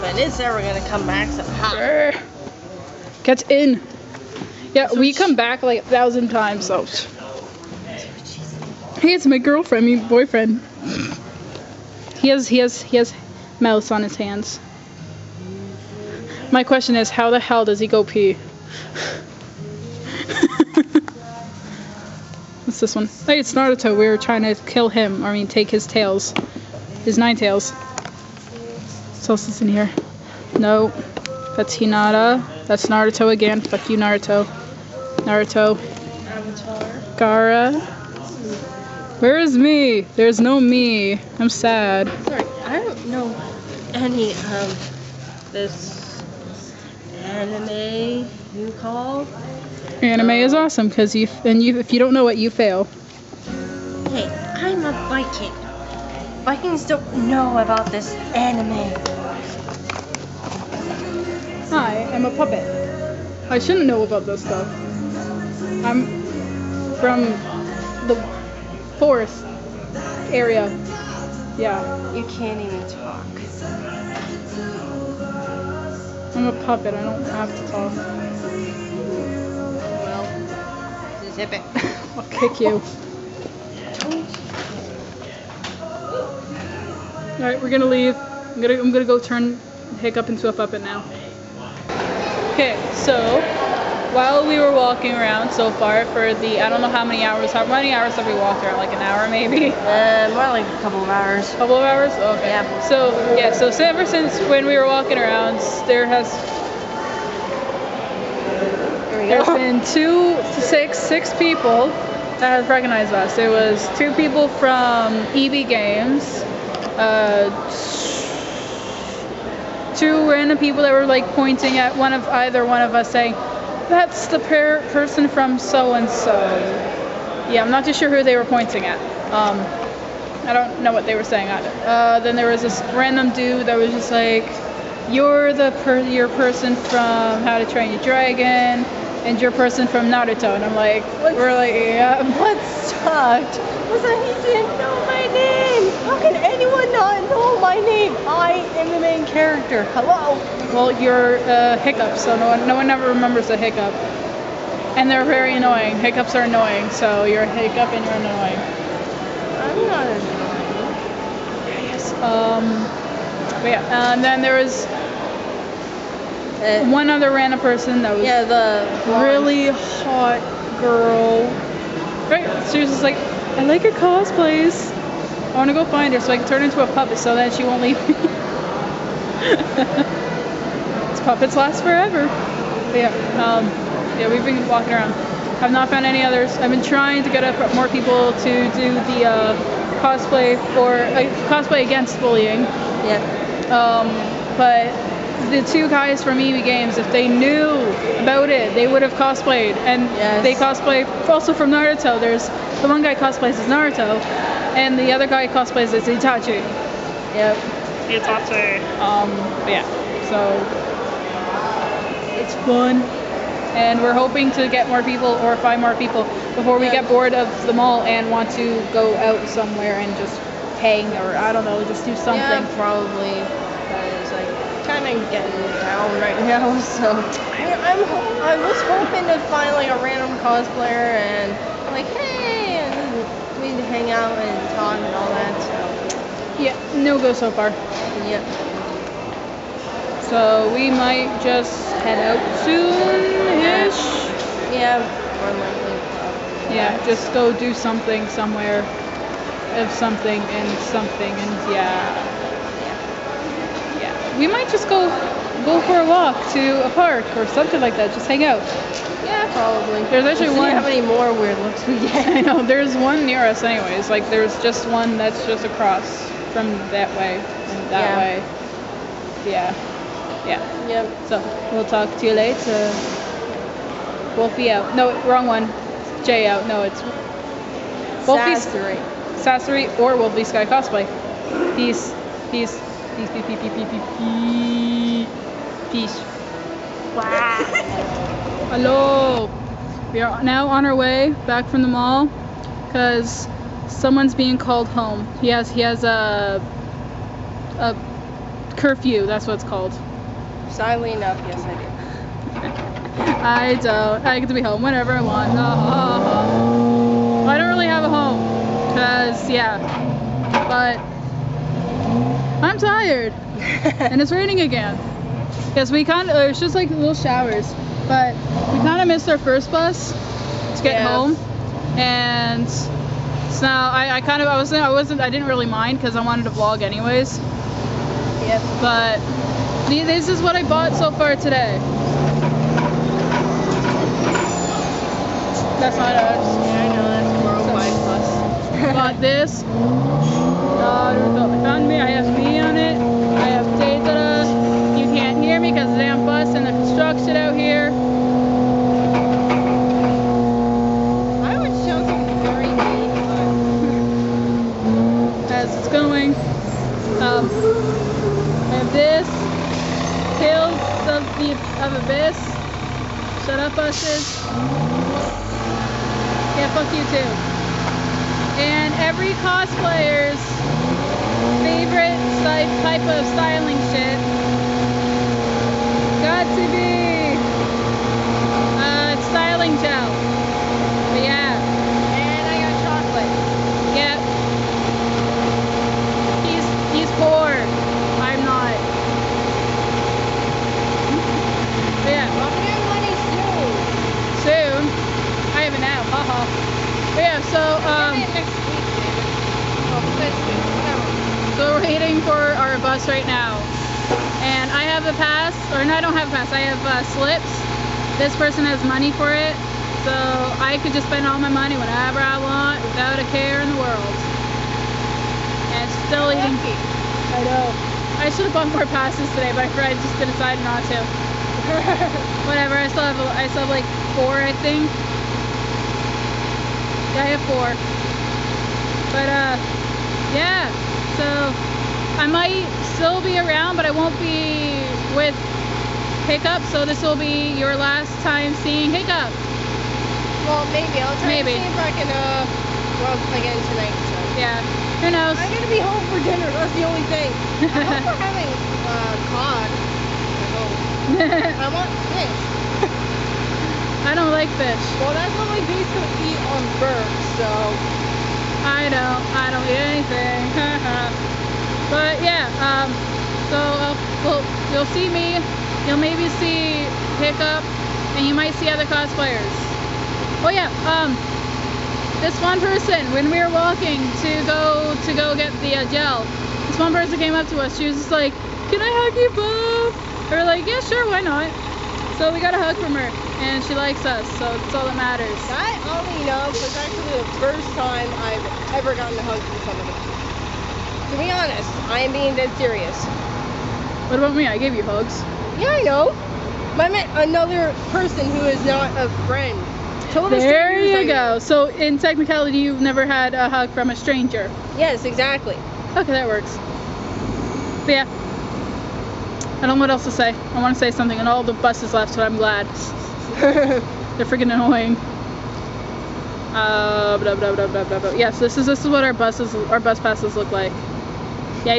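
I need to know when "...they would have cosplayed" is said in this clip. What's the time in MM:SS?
03:18.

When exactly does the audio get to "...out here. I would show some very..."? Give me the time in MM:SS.
05:47.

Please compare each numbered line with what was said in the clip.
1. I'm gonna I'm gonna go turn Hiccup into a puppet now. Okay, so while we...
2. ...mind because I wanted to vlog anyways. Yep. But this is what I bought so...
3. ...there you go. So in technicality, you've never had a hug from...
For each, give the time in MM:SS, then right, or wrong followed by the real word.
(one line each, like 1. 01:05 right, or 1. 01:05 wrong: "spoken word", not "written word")
1. 01:28 right
2. 05:25 right
3. 08:20 right.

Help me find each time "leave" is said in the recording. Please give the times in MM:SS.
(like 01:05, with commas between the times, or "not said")
01:27, 02:57.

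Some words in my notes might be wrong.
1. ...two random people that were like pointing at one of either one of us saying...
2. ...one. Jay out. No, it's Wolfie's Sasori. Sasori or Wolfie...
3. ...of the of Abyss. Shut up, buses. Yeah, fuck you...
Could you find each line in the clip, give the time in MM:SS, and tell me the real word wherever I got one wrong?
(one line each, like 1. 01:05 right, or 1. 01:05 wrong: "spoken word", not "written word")
1. 01:59 right
2. 04:35 right
3. 06:01 right.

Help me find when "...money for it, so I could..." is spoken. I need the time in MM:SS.
06:48.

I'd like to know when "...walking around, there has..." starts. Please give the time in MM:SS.
01:44.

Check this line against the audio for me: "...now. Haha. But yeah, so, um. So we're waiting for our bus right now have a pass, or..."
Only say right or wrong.
right.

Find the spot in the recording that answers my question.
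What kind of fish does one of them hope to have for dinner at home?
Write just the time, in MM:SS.
07:29.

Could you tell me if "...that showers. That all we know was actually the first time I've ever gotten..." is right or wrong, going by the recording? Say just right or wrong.
wrong.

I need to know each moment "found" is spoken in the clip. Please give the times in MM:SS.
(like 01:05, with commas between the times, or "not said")
03:05, 05:41.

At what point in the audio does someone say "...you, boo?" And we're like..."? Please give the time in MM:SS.
07:59.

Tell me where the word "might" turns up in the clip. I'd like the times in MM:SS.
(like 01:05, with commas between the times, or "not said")
04:00, 04:14, 07:12, 07:48.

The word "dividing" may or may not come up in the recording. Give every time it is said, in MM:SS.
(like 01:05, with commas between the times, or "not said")
not said.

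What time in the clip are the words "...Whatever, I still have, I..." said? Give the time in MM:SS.
07:02.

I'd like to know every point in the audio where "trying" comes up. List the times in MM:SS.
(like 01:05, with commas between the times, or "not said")
00:24, 03:06.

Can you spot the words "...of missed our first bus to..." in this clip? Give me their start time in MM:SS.
05:19.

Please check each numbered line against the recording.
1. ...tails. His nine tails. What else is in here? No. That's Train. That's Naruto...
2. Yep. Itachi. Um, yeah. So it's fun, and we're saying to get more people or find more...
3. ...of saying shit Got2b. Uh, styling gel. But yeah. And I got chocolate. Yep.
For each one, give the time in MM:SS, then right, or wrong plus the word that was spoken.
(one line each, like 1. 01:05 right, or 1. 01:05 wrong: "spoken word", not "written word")
1. 00:25 wrong: "Hinata", not "Train"
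2. 03:27 wrong: "hoping", not "saying"
3. 06:13 wrong: "styling", not "saying".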